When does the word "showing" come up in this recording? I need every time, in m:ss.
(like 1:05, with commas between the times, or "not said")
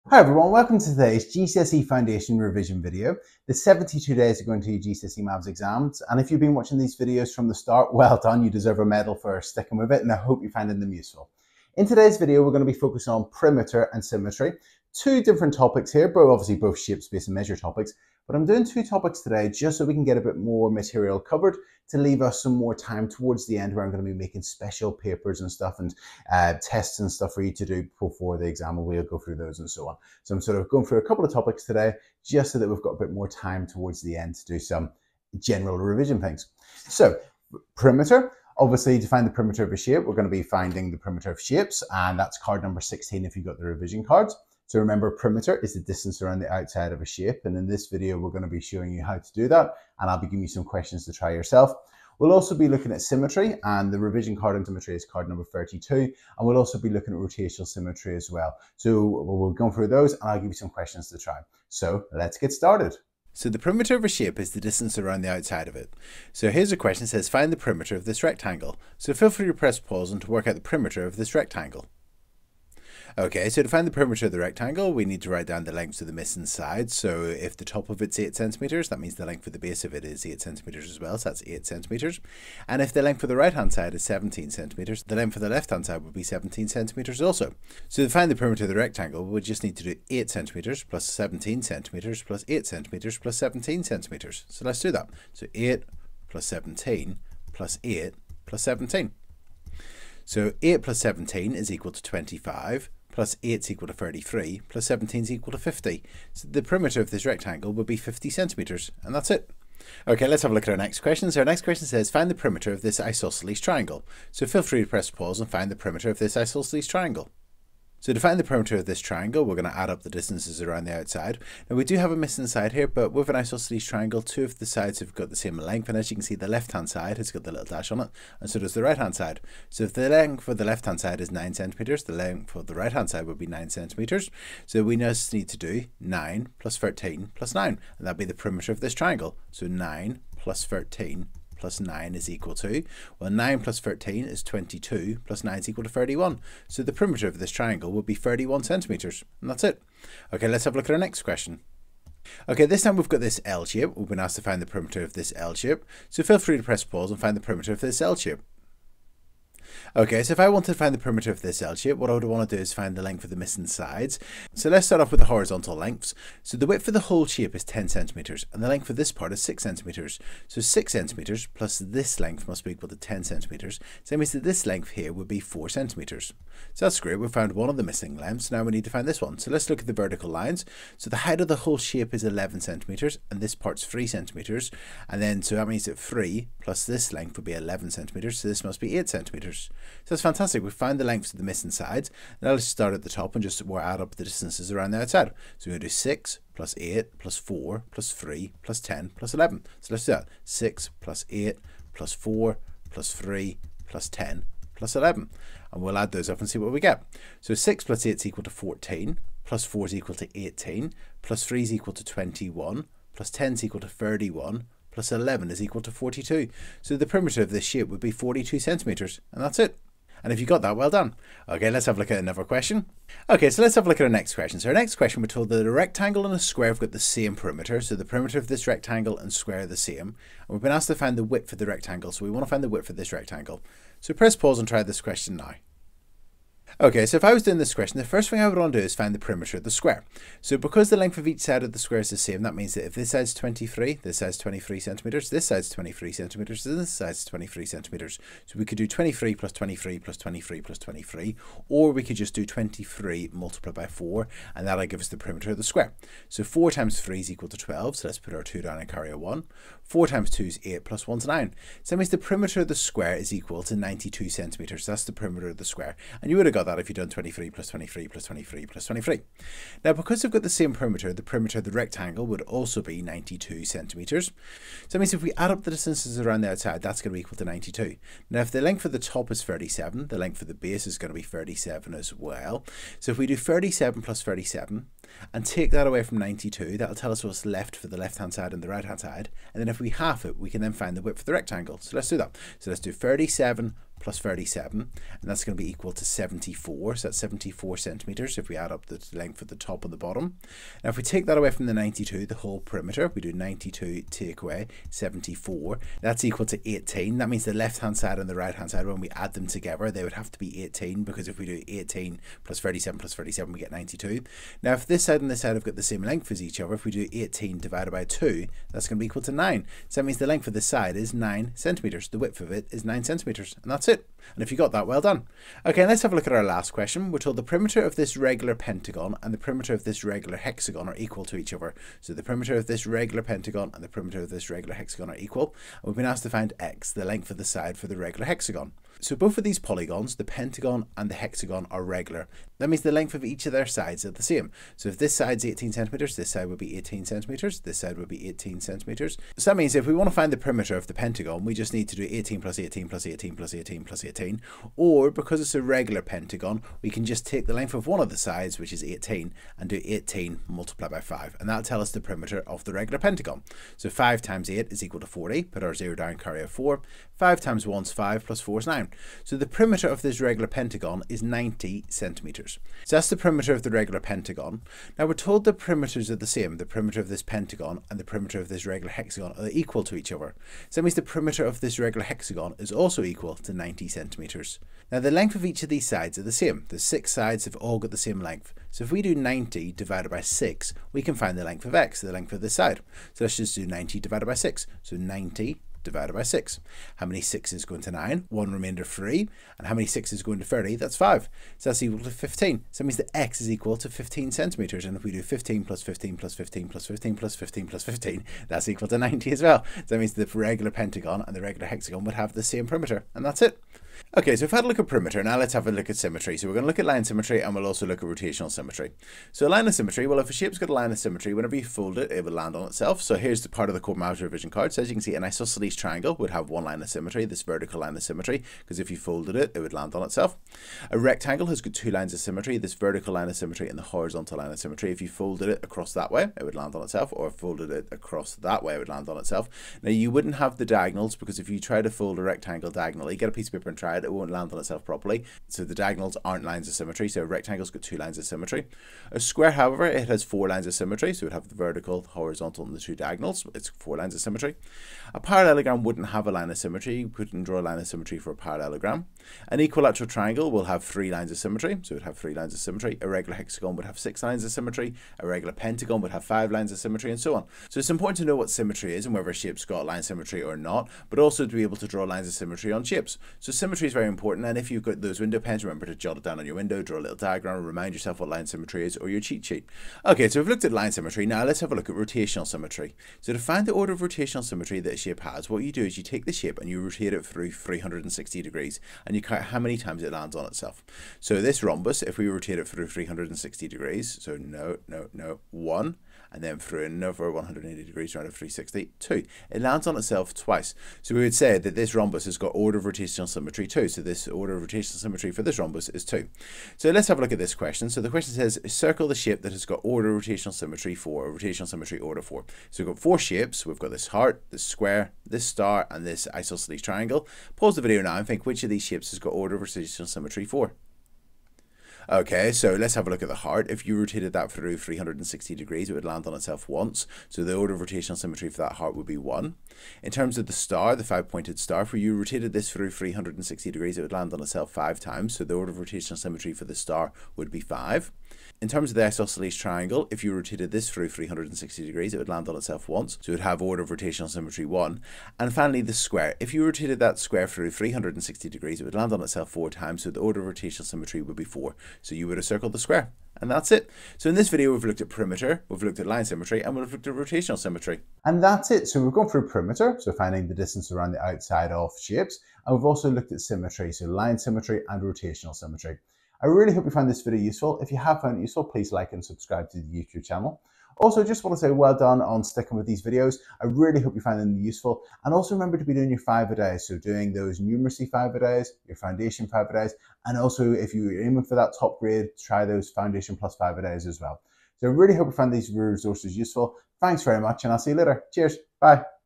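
0:48.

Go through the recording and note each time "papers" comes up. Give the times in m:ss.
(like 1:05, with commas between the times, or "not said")
0:24, 7:23.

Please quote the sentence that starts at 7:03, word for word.
So here's the part of the Corbettmaths revision card.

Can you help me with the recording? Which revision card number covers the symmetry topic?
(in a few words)
32.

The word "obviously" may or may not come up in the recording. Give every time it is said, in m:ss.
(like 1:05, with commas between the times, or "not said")
0:16, 0:38.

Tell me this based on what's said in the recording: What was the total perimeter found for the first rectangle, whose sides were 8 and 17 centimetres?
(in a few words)
50 centimetres.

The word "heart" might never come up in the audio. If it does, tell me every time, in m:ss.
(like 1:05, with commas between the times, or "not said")
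8:34, 8:43, 8:48.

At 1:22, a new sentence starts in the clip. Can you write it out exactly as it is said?
And if the length of the right-hand side is 17 centimeters, the length of the left-hand side would be 17 centimeters also.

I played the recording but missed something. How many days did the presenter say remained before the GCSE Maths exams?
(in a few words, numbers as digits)
72.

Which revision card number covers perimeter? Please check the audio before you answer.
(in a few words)
16.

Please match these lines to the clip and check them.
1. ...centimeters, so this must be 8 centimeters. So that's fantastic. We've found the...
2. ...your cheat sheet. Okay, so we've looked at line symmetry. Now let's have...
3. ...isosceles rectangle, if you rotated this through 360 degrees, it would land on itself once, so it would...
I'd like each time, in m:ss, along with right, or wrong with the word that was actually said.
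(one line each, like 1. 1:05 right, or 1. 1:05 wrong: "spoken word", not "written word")
1. 3:07 right
2. 7:59 right
3. 8:59 wrong: "triangle", not "rectangle".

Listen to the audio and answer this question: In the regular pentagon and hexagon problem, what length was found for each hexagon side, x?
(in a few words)
15 centimetres.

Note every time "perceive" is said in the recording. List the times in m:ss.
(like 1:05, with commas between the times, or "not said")
not said.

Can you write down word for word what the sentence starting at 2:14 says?
So we just need to do 9 plus 13 plus 9, and that'd be the perimeter of this triangle.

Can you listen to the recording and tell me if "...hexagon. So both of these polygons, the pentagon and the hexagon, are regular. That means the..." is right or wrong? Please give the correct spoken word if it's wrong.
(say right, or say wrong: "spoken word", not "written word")
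right.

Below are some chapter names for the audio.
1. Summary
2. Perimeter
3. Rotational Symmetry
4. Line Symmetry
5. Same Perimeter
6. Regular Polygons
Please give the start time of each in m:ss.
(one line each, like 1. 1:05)
1. 9:17
2. 1:02
3. 7:59
4. 6:53
5. 3:43
6. 5:25.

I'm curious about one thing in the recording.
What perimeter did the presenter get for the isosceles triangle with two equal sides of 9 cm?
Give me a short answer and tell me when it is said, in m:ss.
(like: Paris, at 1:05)
31 centimetres, at 2:28.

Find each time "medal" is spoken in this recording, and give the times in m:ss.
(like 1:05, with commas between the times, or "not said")
0:08.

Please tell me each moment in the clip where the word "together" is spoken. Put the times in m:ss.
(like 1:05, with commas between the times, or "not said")
5:09.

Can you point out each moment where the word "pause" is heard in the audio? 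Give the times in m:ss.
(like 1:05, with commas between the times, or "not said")
1:09, 1:55, 2:36, 3:54, 8:37.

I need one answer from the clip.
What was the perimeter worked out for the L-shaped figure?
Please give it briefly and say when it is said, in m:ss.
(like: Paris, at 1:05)
42 centimetres, at 3:38.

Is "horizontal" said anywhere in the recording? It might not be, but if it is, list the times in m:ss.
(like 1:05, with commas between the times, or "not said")
2:45, 7:13, 7:32.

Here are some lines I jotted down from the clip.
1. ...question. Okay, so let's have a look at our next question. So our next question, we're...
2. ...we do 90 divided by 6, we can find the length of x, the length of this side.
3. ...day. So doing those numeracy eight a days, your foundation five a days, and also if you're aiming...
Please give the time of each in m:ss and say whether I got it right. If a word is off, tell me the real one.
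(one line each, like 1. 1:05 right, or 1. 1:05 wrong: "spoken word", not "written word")
1. 3:42 right
2. 6:28 right
3. 9:36 wrong: "five", not "eight".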